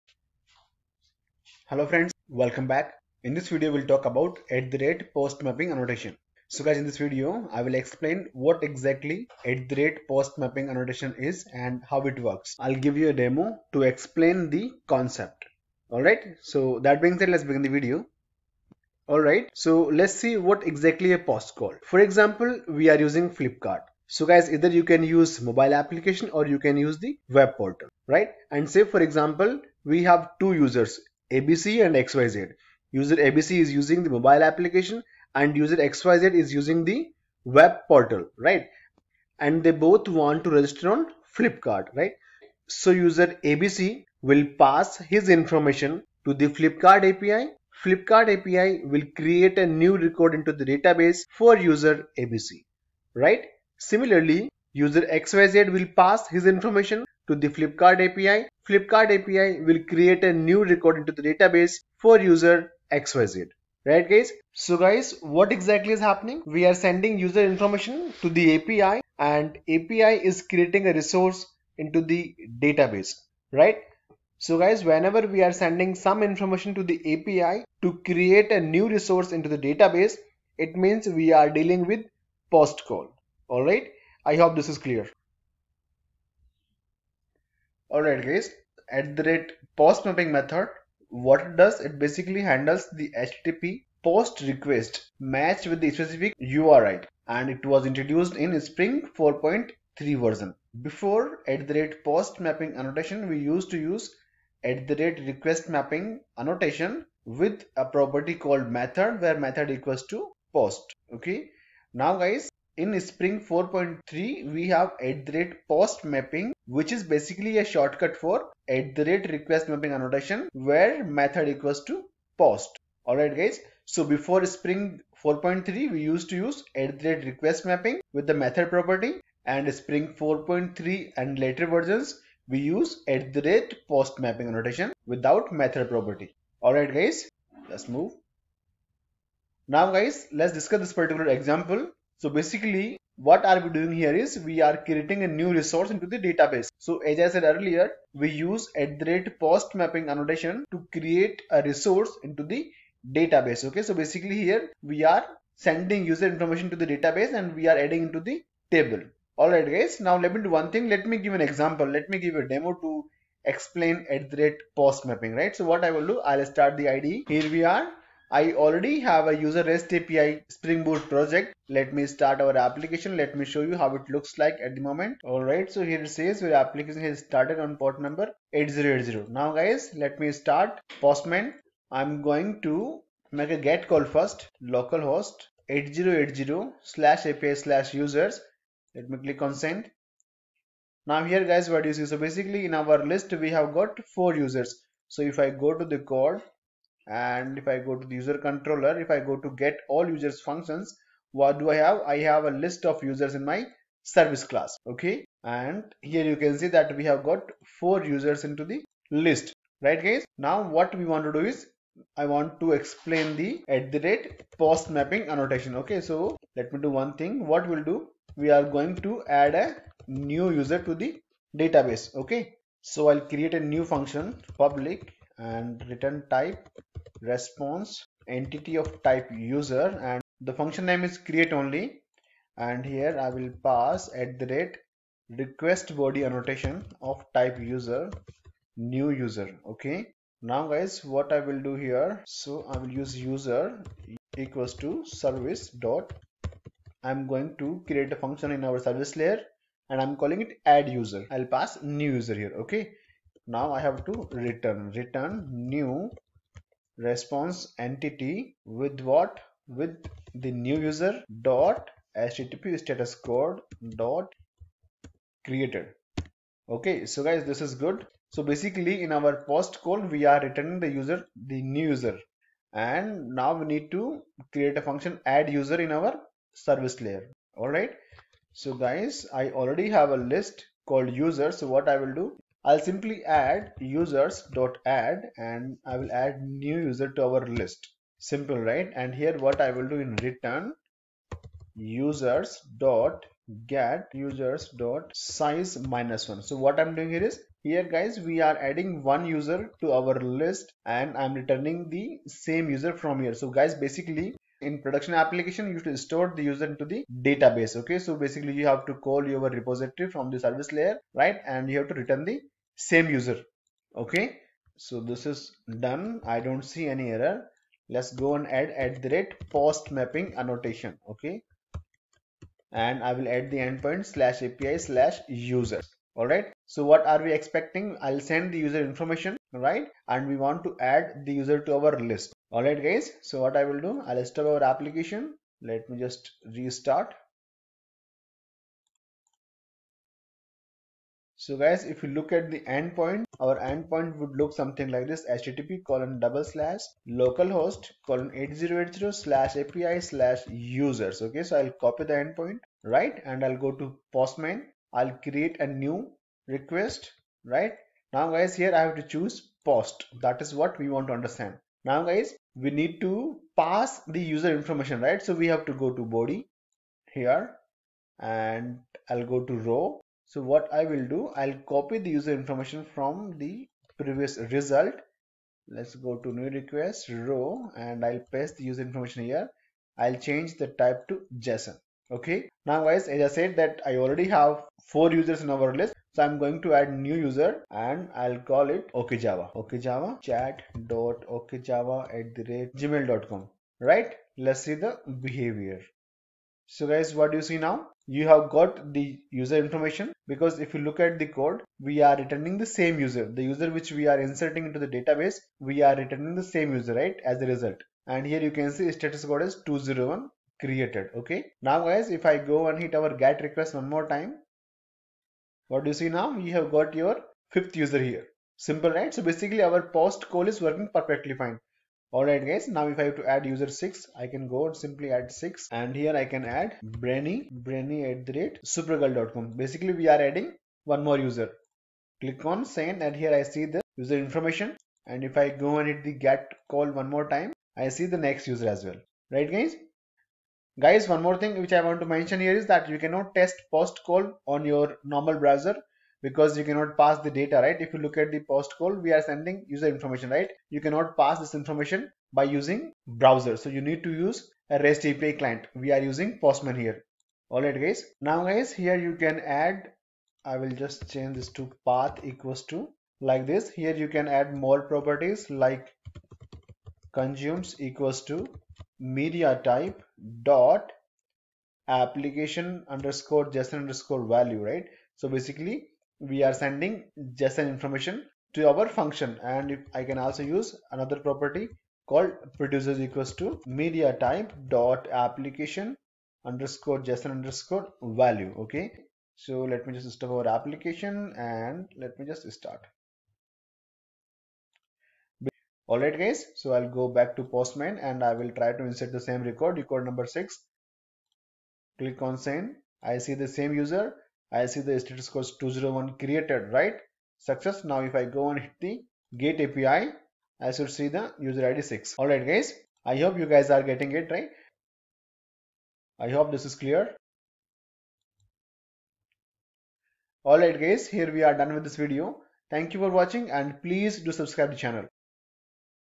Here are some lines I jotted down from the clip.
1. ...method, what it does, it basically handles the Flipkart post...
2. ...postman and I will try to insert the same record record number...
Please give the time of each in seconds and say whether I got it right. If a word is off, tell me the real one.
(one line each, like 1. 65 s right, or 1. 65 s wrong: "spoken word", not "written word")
1. 90 s wrong: "HTTP", not "Flipkart"
2. 497 s right.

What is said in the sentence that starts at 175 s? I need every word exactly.
Alright, so here it says your application has started on port number 8080.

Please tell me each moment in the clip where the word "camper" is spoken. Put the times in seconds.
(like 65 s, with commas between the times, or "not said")
not said.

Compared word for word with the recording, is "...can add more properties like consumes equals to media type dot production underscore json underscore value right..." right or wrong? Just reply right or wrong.
wrong.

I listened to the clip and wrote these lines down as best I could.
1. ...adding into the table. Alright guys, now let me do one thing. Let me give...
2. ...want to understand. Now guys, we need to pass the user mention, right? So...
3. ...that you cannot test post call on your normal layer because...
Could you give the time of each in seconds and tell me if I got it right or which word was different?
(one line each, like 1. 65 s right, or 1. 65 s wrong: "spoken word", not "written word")
1. 157 s right
2. 360 s wrong: "information", not "mention"
3. 442 s wrong: "browser", not "layer".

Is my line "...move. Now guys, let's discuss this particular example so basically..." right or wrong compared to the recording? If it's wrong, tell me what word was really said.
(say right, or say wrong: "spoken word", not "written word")
right.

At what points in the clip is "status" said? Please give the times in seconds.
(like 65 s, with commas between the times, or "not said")
262 s, 408 s, 505 s.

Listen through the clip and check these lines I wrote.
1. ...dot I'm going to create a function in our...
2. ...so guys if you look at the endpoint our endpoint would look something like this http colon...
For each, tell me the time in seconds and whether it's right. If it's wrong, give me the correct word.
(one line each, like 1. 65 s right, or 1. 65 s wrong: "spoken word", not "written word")
1. 245 s right
2. 341 s right.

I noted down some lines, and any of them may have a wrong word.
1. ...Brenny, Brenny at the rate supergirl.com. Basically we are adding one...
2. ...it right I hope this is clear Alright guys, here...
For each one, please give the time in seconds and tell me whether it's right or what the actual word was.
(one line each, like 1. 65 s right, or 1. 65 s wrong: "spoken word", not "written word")
1. 426 s right
2. 514 s right.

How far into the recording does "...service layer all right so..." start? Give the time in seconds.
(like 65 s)
276 s.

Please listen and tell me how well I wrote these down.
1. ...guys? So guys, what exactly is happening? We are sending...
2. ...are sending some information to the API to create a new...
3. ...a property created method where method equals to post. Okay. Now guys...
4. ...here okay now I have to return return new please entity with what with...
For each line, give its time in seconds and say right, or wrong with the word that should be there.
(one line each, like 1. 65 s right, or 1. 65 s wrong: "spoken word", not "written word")
1. 64 s right
2. 75 s right
3. 107 s wrong: "called", not "created"
4. 252 s wrong: "response", not "please".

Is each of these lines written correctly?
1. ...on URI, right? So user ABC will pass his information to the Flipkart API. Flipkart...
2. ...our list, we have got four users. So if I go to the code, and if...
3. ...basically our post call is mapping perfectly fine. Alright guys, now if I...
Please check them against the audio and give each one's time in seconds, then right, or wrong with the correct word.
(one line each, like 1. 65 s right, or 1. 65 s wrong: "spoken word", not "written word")
1. 40 s wrong: "Flipkart", not "URI"
2. 192 s right
3. 419 s wrong: "working", not "mapping".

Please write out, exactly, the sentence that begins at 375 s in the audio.
Let's go to new request raw and I'll paste the user information here.